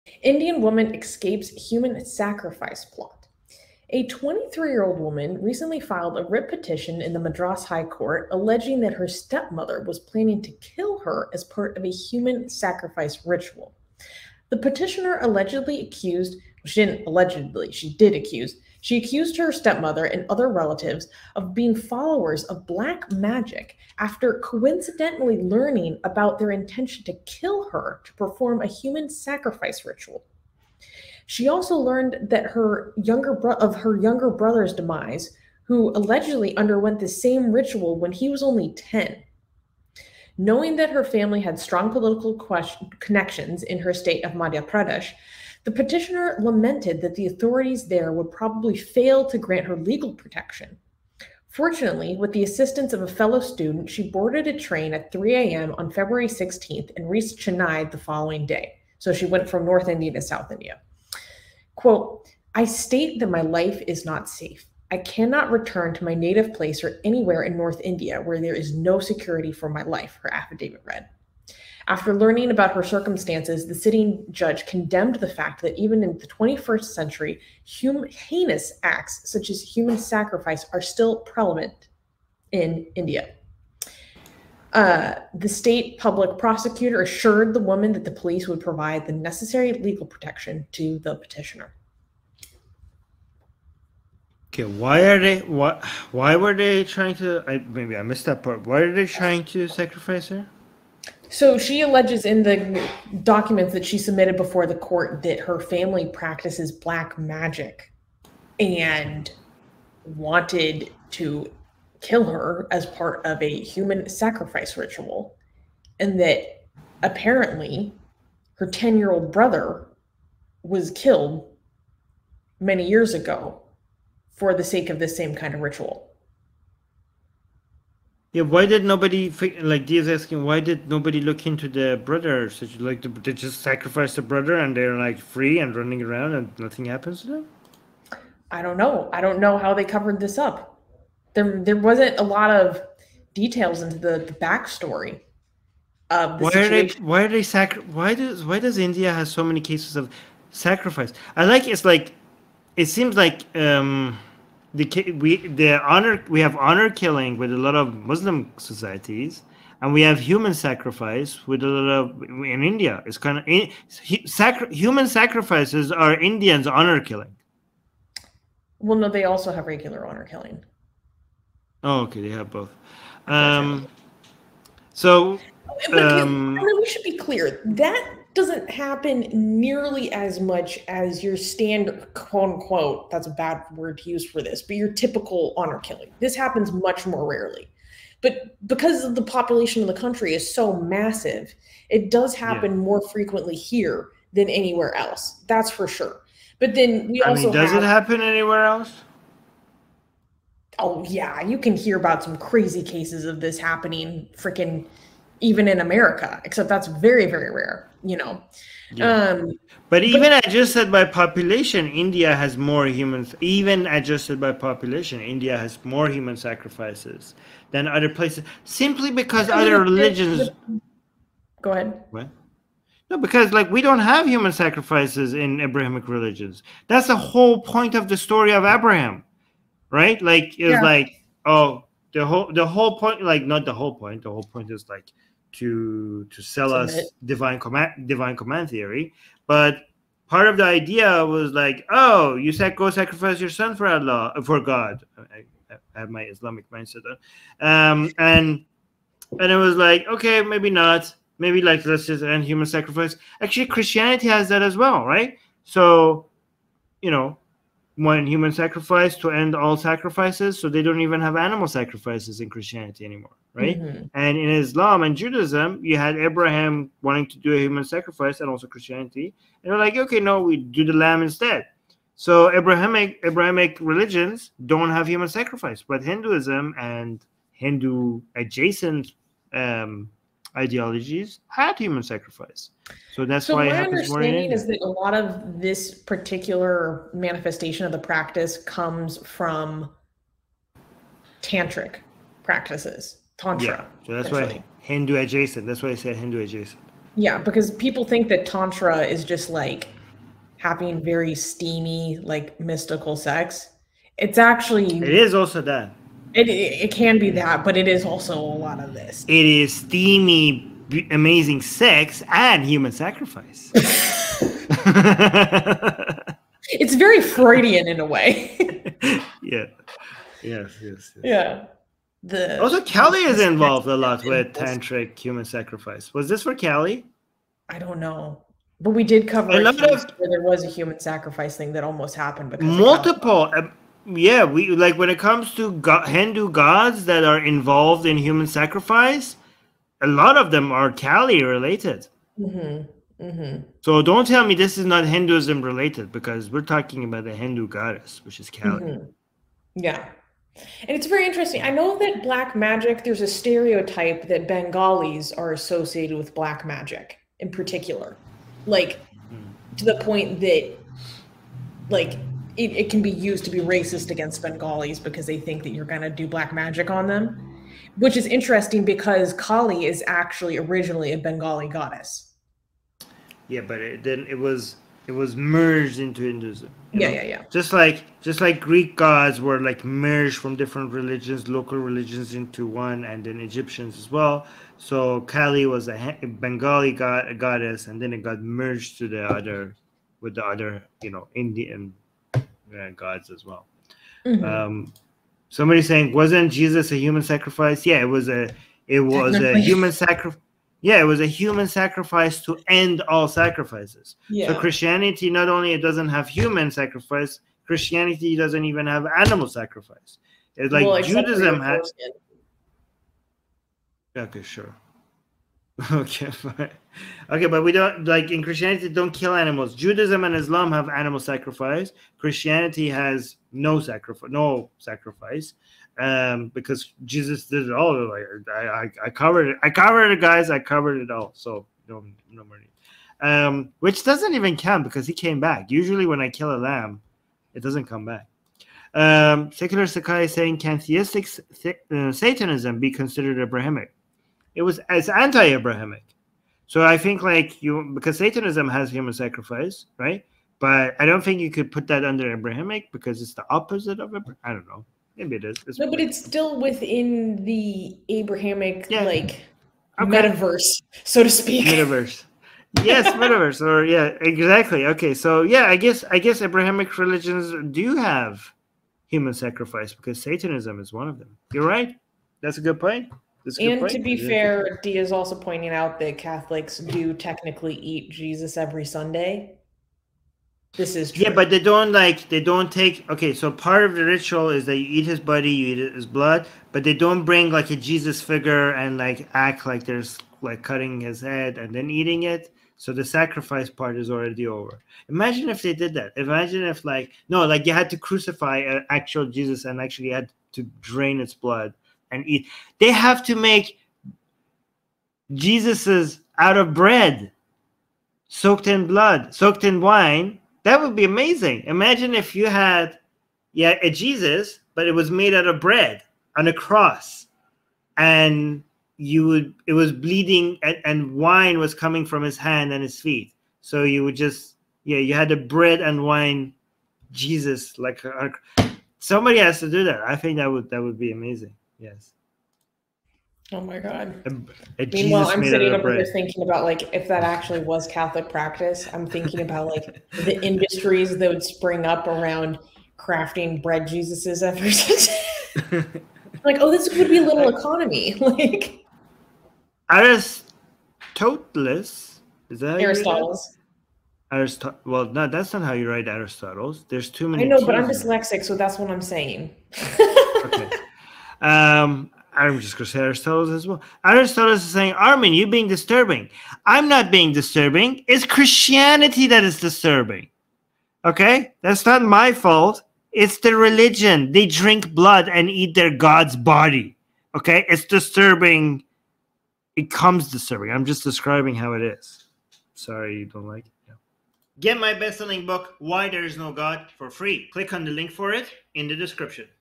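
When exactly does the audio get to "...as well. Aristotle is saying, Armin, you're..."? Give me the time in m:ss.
9:23.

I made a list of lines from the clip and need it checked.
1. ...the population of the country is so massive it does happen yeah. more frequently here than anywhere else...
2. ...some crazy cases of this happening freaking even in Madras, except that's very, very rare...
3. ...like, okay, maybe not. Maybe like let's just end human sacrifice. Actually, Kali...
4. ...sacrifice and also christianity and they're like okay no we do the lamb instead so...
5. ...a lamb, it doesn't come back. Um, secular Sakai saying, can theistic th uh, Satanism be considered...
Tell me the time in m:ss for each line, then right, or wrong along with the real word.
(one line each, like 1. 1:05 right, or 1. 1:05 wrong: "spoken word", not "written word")
1. 3:09 right
2. 3:22 wrong: "America", not "Madras"
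3. 4:09 wrong: "Christianity", not "Kali"
4. 4:27 right
5. 7:16 right.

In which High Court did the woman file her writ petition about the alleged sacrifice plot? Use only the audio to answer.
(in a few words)
Madras High Court.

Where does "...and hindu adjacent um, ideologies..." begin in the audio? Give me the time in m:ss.
4:36.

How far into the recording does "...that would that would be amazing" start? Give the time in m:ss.
8:50.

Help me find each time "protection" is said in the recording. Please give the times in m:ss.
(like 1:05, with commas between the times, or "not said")
0:50, 1:30.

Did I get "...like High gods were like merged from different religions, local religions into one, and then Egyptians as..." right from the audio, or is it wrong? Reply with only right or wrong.
wrong.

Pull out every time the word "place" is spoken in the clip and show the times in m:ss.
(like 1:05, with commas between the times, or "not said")
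1:06, 3:38.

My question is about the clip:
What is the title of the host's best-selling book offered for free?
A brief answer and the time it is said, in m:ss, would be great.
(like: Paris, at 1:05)
Why There Is No God, at 9:45.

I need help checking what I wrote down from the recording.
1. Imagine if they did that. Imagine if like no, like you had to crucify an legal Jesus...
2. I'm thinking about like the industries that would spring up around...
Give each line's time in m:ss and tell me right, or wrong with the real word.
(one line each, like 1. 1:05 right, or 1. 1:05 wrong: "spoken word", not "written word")
1. 8:15 wrong: "actual", not "legal"
2. 8:58 right.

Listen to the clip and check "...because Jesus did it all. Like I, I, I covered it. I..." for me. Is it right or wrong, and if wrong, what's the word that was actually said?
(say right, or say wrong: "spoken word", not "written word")
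right.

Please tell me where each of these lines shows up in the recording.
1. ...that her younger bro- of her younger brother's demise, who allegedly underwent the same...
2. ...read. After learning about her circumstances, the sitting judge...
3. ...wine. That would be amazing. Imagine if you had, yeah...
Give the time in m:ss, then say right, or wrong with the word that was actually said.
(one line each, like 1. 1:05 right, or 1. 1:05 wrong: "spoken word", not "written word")
1. 0:32 right
2. 1:10 right
3. 8:29 right.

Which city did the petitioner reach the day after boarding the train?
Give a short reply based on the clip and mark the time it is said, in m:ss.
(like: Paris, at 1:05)
Chennai, at 0:57.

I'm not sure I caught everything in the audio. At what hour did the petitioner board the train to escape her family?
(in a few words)
3 a.m.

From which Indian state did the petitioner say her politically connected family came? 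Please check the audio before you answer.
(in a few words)
Madhya Pradesh.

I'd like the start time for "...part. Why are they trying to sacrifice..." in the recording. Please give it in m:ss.
1:38.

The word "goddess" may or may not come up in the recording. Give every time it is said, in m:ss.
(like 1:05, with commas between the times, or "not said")
5:47, 6:11, 6:27.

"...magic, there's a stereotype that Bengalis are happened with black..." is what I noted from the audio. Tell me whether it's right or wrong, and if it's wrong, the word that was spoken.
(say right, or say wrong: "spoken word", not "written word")
wrong: "associated", not "happened".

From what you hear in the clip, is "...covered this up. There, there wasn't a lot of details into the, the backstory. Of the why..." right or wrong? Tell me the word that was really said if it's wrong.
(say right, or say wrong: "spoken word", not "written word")
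right.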